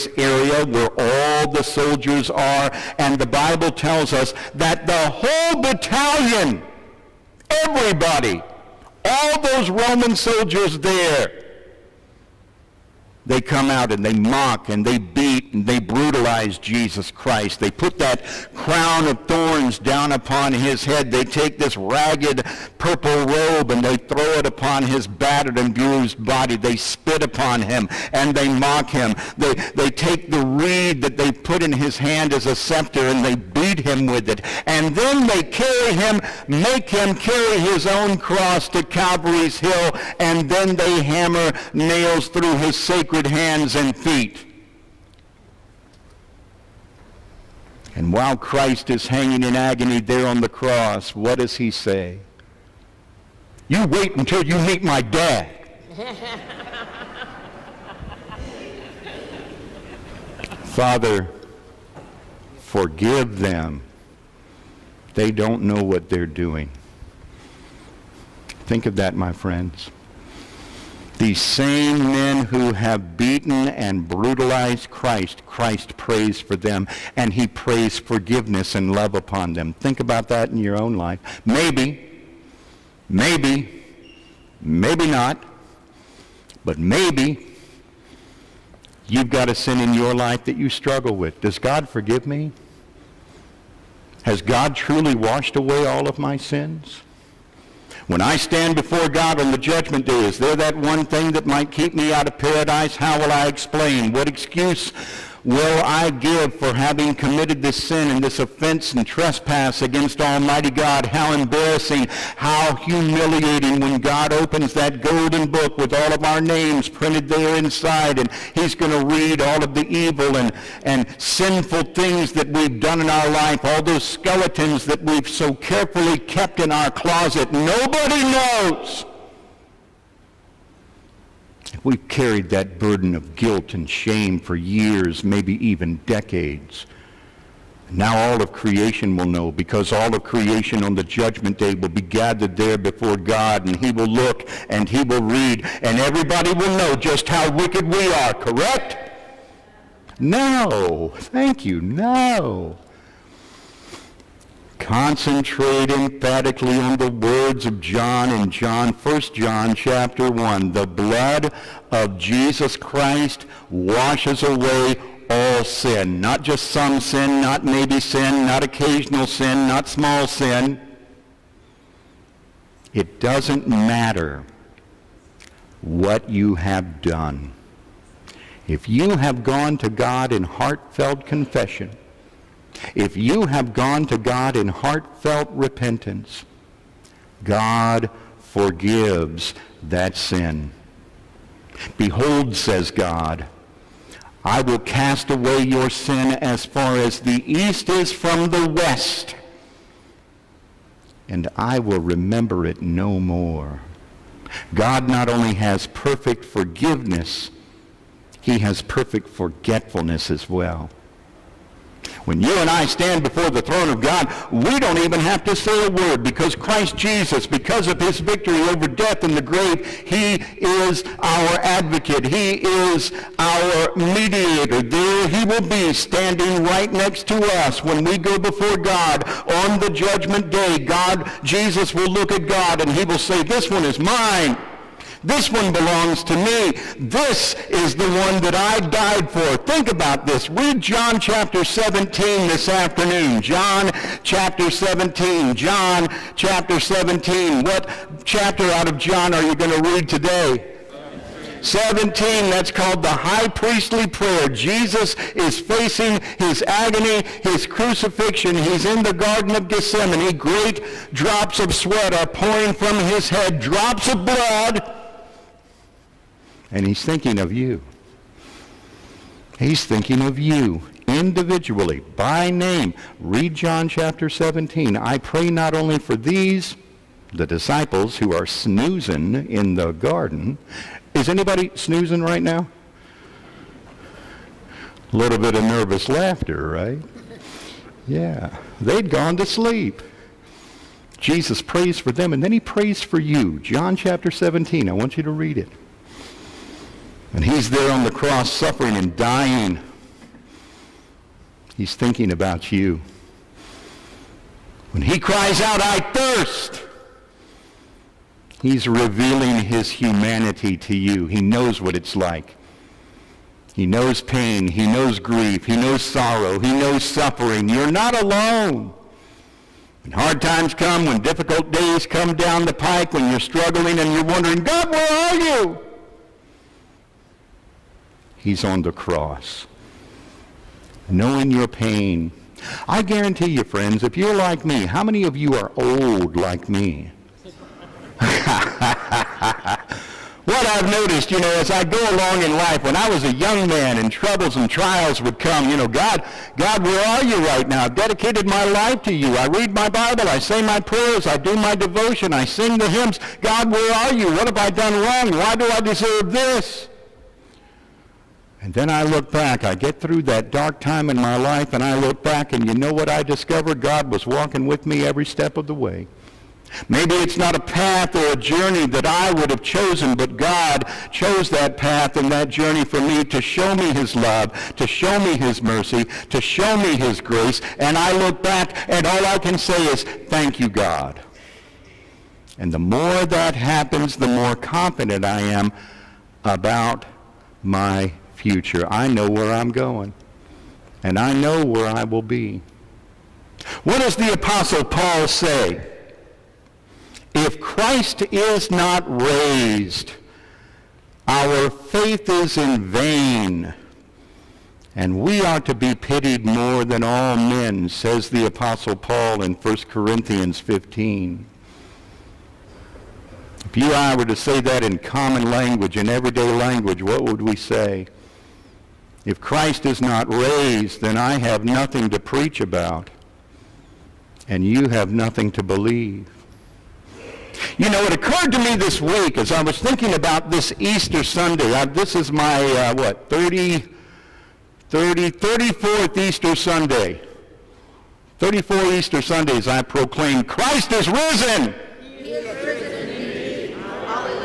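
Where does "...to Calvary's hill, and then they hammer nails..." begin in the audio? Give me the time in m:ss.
0:38.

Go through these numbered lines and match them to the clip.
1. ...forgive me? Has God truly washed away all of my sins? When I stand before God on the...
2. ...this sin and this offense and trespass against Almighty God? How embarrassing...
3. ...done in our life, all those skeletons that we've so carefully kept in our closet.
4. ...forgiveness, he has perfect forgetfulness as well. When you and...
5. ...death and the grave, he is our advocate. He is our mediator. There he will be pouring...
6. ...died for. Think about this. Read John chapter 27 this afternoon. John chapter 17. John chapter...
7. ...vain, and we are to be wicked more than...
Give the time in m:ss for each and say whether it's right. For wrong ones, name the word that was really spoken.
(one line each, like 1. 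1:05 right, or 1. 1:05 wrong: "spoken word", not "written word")
1. 1:31 right
2. 1:47 right
3. 2:02 right
4. 3:26 right
5. 3:38 wrong: "standing", not "pouring"
6. 3:58 wrong: "17", not "27"
7. 6:42 wrong: "pitied", not "wicked".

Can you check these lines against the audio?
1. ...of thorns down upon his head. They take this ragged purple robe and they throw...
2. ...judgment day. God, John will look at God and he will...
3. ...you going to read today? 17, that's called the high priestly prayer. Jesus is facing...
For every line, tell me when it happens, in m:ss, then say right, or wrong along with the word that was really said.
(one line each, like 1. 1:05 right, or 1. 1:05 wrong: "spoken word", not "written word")
1. 0:19 right
2. 3:49 wrong: "Jesus", not "John"
3. 4:09 right.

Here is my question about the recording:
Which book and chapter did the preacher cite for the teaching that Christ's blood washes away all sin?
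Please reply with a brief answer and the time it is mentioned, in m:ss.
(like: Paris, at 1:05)
1 John chapter 1, at 2:38.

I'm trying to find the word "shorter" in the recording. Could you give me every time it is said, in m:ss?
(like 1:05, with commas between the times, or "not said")
not said.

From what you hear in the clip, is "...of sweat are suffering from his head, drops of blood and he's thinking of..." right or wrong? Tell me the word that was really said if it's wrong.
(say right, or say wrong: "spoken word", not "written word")
wrong: "pouring", not "suffering".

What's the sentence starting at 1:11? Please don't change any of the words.
These same men who have beaten and brutalized Christ, Christ prays for them, and he prays forgiveness and love upon them.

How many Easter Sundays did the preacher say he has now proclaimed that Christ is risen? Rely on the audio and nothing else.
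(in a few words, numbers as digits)
34.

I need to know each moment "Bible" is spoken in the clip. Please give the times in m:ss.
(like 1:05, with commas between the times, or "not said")
0:03, 5:49.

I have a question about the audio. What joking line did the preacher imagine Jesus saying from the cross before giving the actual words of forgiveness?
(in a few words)
You wait until you meet my dad.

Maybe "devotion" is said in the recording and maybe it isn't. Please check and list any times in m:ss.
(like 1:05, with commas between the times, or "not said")
5:51.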